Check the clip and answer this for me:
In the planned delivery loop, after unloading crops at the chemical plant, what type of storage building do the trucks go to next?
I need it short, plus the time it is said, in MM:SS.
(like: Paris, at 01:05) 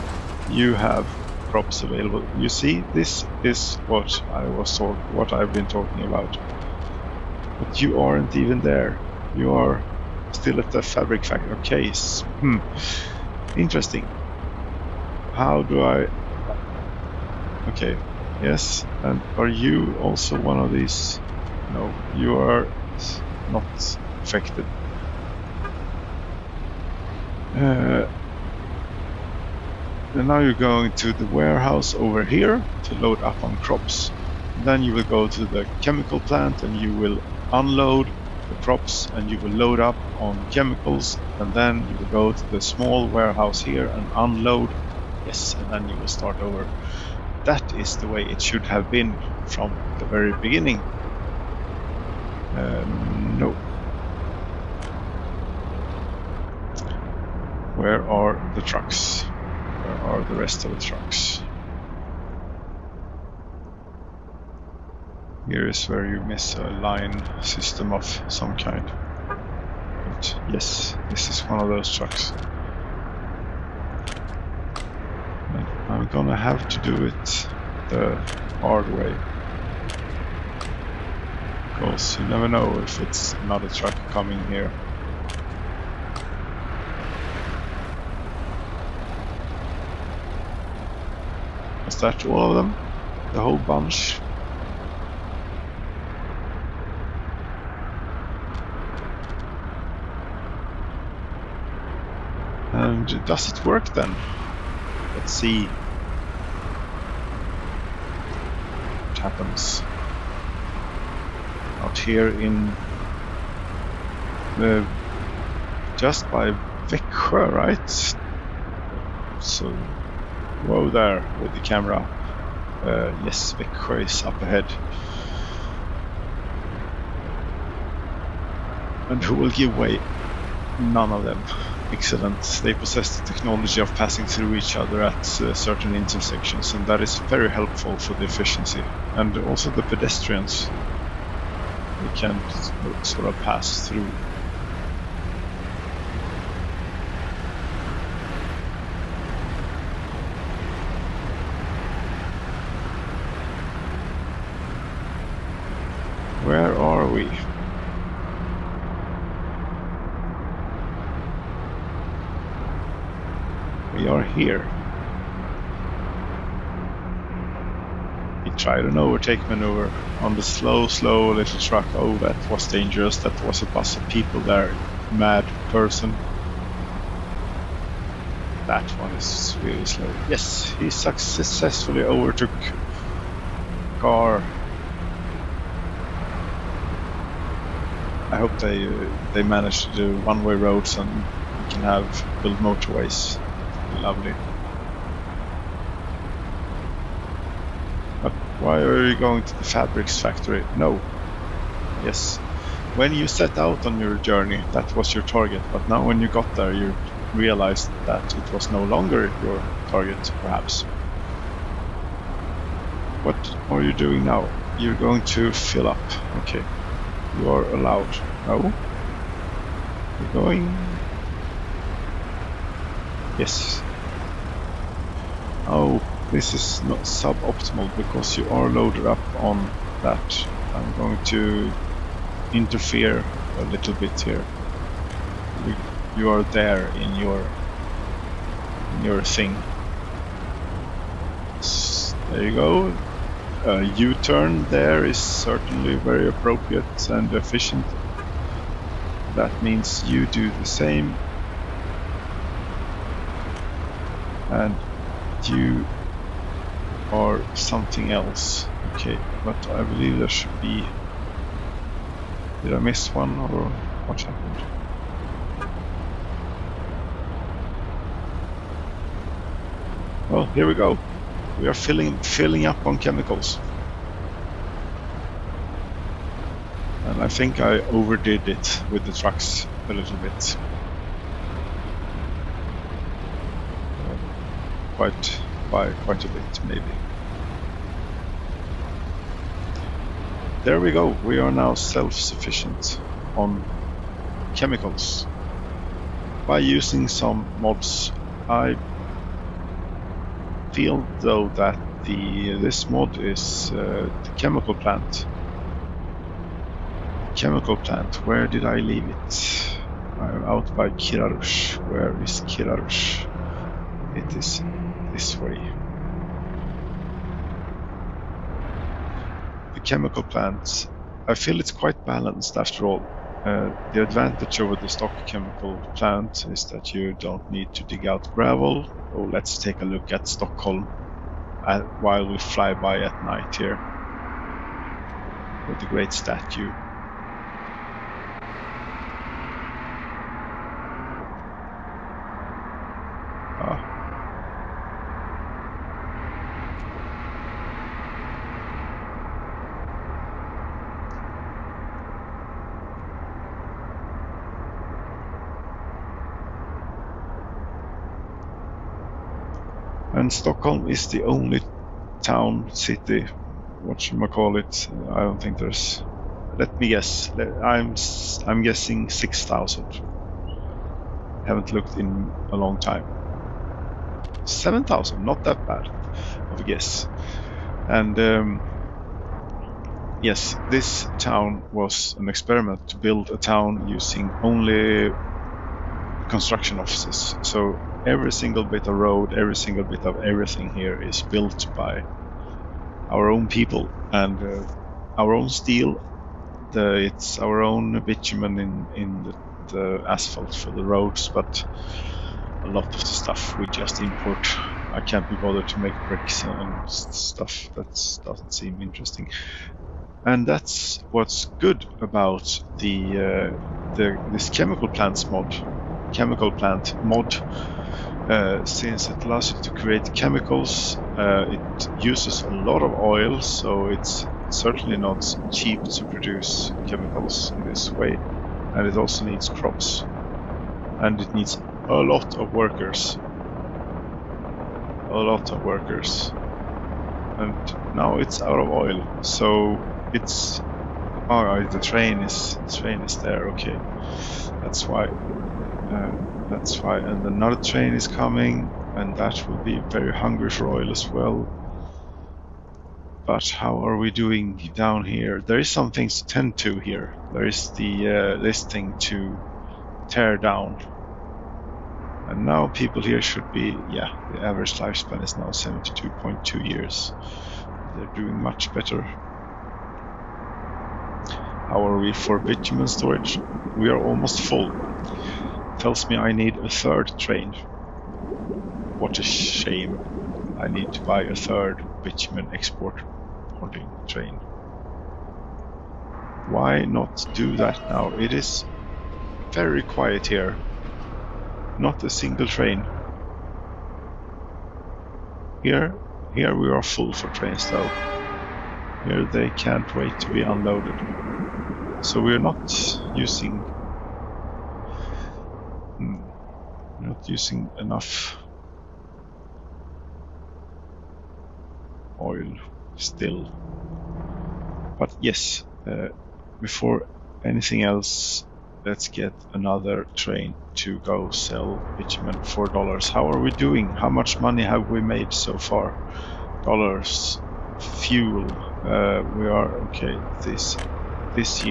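small warehouse, at 00:42.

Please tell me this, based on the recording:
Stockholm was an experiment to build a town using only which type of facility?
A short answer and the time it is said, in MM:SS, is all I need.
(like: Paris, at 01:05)
construction offices, at 06:26.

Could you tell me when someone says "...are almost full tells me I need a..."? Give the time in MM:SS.
07:53.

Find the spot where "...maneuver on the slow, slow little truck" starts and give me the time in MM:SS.
02:49.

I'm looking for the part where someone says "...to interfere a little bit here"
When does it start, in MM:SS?
03:51.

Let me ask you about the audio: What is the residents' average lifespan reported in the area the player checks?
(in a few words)
72.2 years.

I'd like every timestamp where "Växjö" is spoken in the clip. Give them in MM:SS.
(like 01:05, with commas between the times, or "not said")
01:56, 02:03.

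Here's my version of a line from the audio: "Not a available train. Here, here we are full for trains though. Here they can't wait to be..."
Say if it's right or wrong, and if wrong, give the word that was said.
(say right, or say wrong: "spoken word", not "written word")
wrong: "single", not "available".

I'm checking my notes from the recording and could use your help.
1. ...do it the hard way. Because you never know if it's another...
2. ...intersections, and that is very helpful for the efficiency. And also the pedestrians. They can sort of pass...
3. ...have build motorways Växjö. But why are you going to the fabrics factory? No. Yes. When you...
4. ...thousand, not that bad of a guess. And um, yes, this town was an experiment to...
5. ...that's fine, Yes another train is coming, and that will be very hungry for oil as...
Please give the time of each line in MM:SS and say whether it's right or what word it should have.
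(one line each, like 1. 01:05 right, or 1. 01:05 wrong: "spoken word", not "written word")
1. 01:16 right
2. 02:15 right
3. 03:11 wrong: "Lovely", not "Växjö"
4. 06:14 right
5. 07:26 wrong: "And", not "Yes".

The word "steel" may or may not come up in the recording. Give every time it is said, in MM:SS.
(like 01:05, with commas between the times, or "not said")
06:35.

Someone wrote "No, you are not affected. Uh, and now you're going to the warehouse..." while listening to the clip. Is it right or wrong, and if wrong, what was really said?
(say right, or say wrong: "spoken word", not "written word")
right.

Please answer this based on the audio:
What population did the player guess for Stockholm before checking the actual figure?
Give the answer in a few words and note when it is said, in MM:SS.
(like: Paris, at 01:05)
6000, at 06:09.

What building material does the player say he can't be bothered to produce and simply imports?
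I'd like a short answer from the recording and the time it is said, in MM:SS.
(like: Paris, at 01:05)
bricks, at 06:46.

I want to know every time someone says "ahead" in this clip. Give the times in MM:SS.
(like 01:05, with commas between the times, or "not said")
02:04.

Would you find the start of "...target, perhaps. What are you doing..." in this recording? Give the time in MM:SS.
03:29.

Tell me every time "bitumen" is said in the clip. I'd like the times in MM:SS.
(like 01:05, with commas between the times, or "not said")
06:38, 07:52, 08:02, 08:41.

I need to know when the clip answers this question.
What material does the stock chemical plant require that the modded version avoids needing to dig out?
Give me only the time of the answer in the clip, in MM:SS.
05:28.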